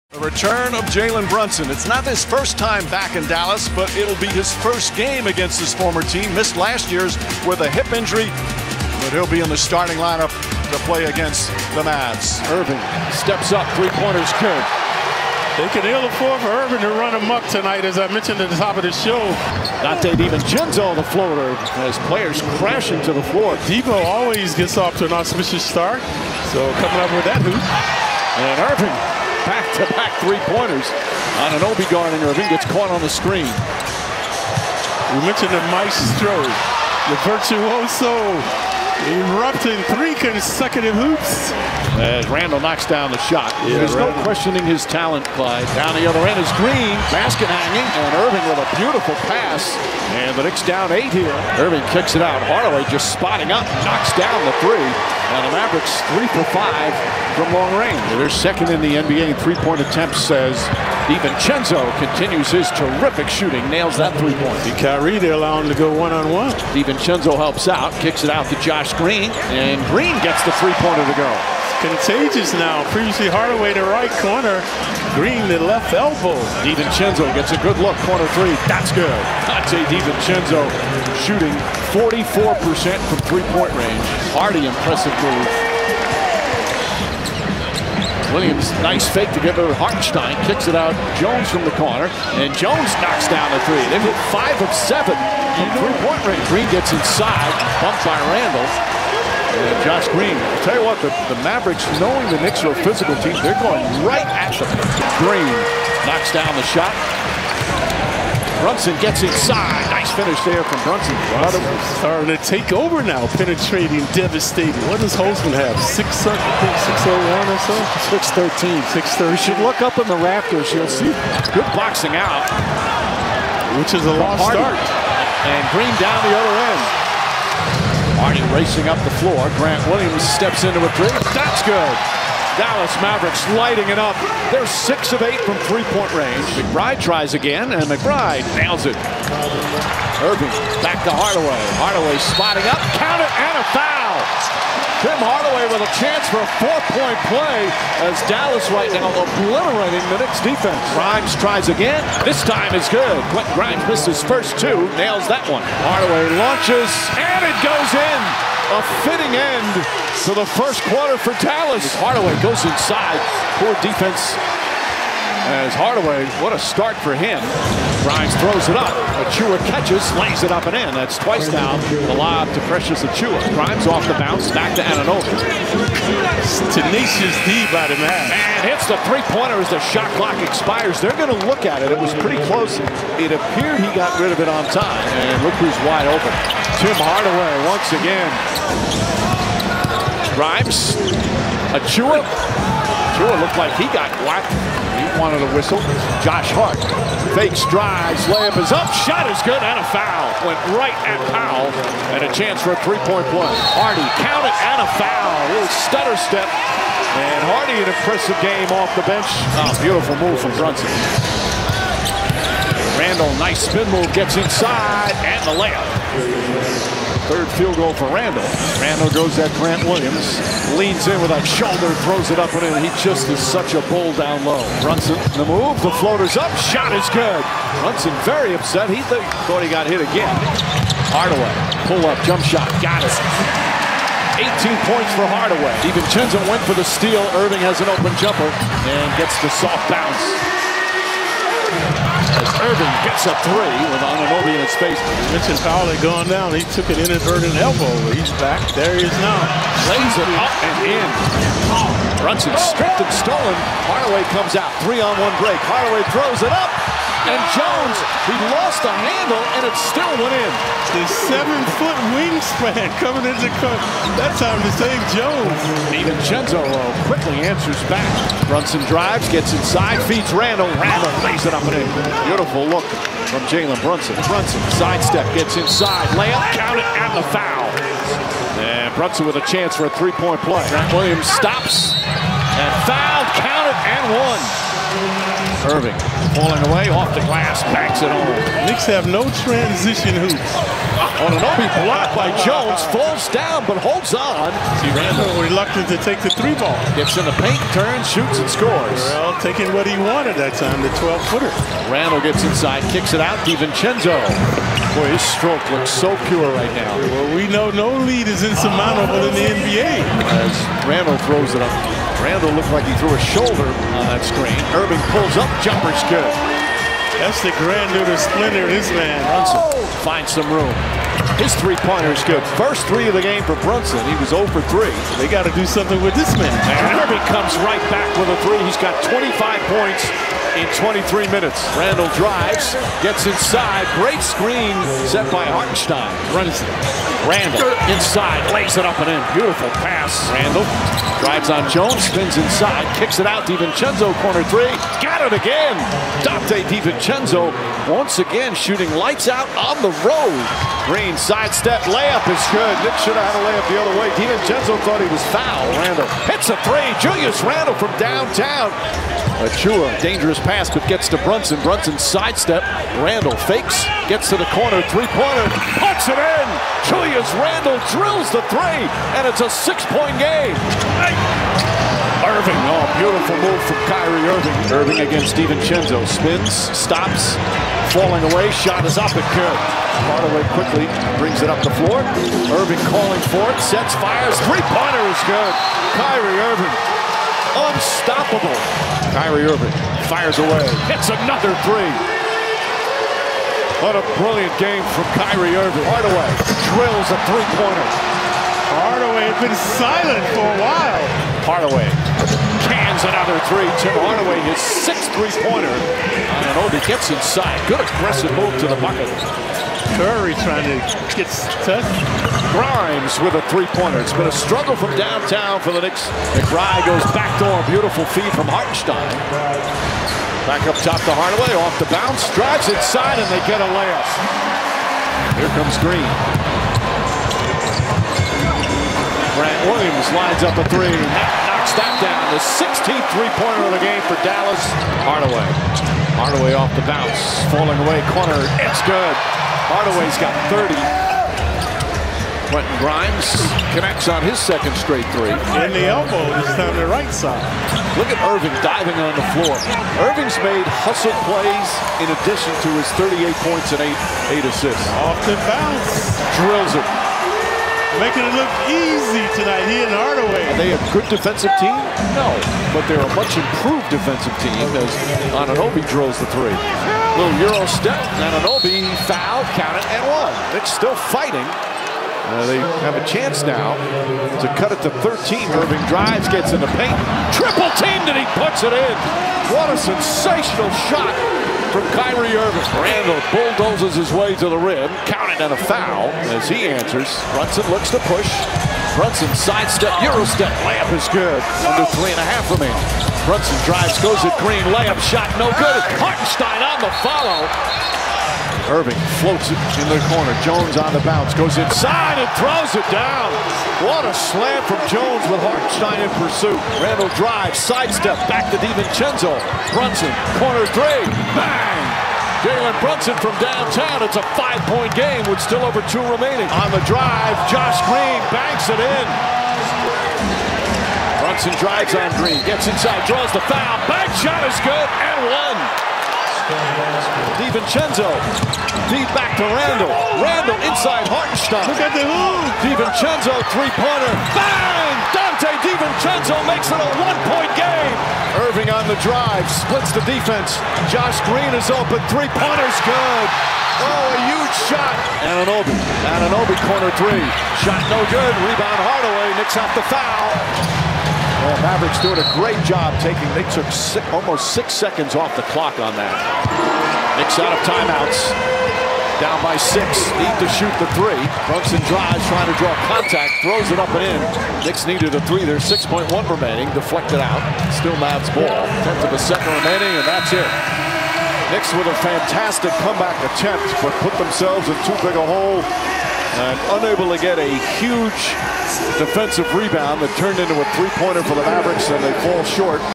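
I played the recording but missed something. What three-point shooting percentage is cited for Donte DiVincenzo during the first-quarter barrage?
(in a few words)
44%.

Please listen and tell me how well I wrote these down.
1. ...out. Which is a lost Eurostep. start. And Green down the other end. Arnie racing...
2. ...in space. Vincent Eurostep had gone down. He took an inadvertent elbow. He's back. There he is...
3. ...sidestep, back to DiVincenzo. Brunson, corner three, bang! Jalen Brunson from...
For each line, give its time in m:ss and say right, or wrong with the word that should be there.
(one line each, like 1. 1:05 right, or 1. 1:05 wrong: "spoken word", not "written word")
1. 2:02 wrong: "Hardy", not "Eurostep"
2. 4:04 wrong: "Powell", not "Eurostep"
3. 8:27 right.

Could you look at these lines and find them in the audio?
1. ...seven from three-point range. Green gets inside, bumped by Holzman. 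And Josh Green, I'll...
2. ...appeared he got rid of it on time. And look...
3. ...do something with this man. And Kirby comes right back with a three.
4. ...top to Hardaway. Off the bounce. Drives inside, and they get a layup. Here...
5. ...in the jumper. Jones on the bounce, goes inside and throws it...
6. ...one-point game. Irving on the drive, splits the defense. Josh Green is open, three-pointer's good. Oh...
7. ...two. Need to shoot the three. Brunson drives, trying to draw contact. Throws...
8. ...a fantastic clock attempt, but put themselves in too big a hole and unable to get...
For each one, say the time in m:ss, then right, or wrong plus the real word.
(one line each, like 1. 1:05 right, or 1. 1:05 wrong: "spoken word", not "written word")
1. 1:34 wrong: "Randle", not "Holzman"
2. 3:03 right
3. 5:25 right
4. 7:00 right
5. 8:19 wrong: "corner", not "jumper"
6. 8:57 right
7. 9:19 wrong: "six", not "two"
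8. 9:31 wrong: "comeback", not "clock".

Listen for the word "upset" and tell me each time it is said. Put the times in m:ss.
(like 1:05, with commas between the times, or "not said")
3:48.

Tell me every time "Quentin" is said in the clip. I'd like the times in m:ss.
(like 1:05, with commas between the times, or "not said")
2:33, 7:22.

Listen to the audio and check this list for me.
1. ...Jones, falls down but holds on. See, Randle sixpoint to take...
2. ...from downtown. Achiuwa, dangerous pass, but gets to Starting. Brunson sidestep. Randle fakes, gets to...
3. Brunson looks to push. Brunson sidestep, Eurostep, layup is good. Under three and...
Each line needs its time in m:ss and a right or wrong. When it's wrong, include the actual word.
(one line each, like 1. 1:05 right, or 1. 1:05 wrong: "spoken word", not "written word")
1. 4:52 wrong: "reluctant", not "sixpoint"
2. 5:57 wrong: "Brunson", not "Starting"
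3. 8:07 right.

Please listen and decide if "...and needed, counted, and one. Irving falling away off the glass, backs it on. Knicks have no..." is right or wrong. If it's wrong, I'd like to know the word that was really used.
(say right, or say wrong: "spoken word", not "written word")
wrong: "fouled", not "needed".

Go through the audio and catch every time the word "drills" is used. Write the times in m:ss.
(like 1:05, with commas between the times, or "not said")
6:07, 6:36, 7:36, 7:45.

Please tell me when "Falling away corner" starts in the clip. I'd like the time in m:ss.
7:17.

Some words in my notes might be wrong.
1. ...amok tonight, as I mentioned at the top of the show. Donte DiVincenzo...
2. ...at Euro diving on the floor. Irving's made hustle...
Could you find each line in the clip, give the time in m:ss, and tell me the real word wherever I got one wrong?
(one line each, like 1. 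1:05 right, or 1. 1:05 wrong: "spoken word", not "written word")
1. 0:17 right
2. 7:28 wrong: "Irving", not "Euro".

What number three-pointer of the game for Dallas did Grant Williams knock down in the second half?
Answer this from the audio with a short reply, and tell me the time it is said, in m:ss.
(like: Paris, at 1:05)
16th, at 7:12.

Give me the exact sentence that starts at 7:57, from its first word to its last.
Triple teamed, and he puts it in.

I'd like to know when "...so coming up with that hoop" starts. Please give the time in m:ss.
0:26.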